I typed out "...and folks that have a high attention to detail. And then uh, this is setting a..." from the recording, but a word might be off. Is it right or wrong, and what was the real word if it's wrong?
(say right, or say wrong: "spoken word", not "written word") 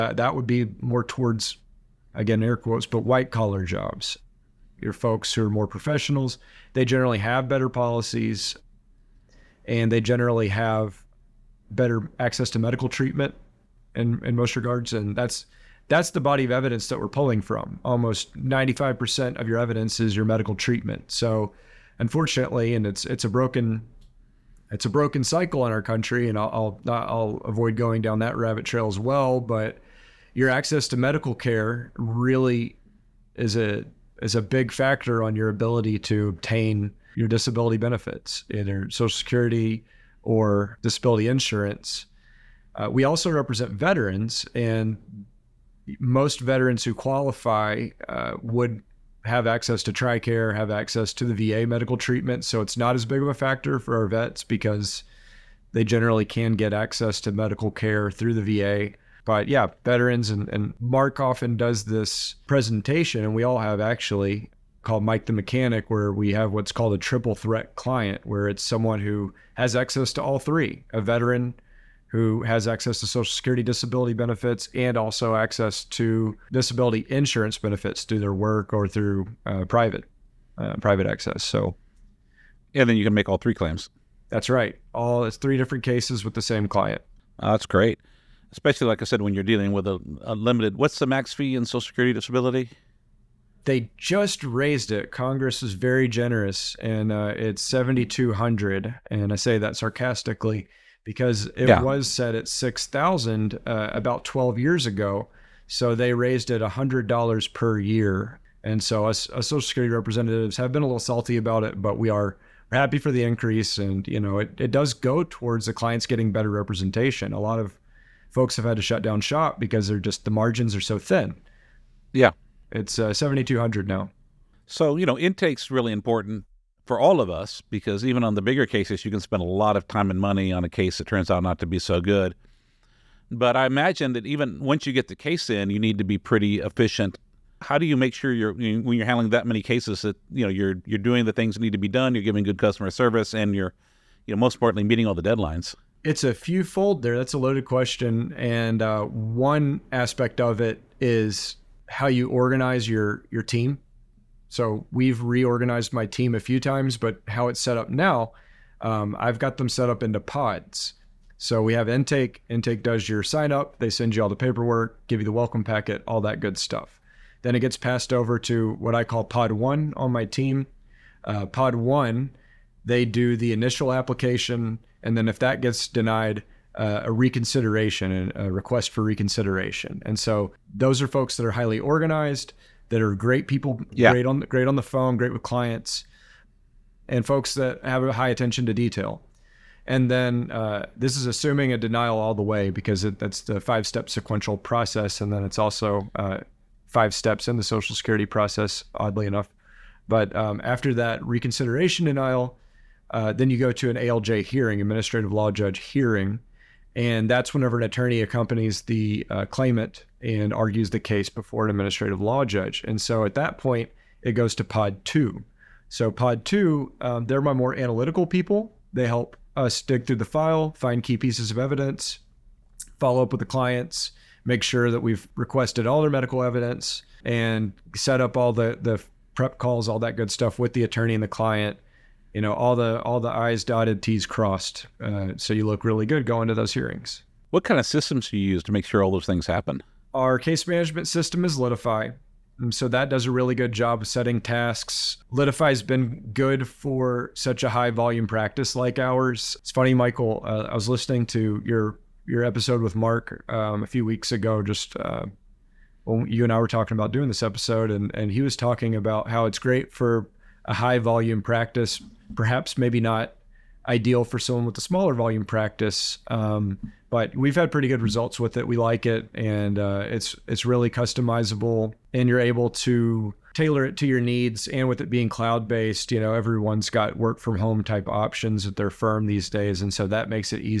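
wrong: "assuming", not "setting".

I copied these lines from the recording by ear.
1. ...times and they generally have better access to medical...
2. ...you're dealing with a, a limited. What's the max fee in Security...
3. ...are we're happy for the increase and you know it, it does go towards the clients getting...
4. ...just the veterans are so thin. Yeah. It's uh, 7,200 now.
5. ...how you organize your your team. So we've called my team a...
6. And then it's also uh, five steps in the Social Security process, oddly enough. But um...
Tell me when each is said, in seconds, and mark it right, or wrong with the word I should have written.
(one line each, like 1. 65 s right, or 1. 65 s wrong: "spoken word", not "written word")
1. 7 s wrong: "policies", not "times"
2. 89 s wrong: "Social", not "Security"
3. 112 s right
4. 119 s wrong: "margins", not "veterans"
5. 151 s wrong: "reorganized", not "called"
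6. 195 s right.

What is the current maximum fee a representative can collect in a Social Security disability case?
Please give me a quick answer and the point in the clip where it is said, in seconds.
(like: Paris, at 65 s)
$7,200, at 97 s.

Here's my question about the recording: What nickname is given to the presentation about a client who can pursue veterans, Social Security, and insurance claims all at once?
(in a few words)
Mike the Mechanic.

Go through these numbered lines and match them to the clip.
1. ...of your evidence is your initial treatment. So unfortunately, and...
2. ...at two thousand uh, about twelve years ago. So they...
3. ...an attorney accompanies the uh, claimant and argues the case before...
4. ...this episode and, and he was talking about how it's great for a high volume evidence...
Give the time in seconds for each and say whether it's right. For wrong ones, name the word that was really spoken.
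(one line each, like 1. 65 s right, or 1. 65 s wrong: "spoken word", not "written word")
1. 19 s wrong: "medical", not "initial"
2. 102 s wrong: "six", not "two"
3. 207 s right
4. 257 s wrong: "practice", not "evidence".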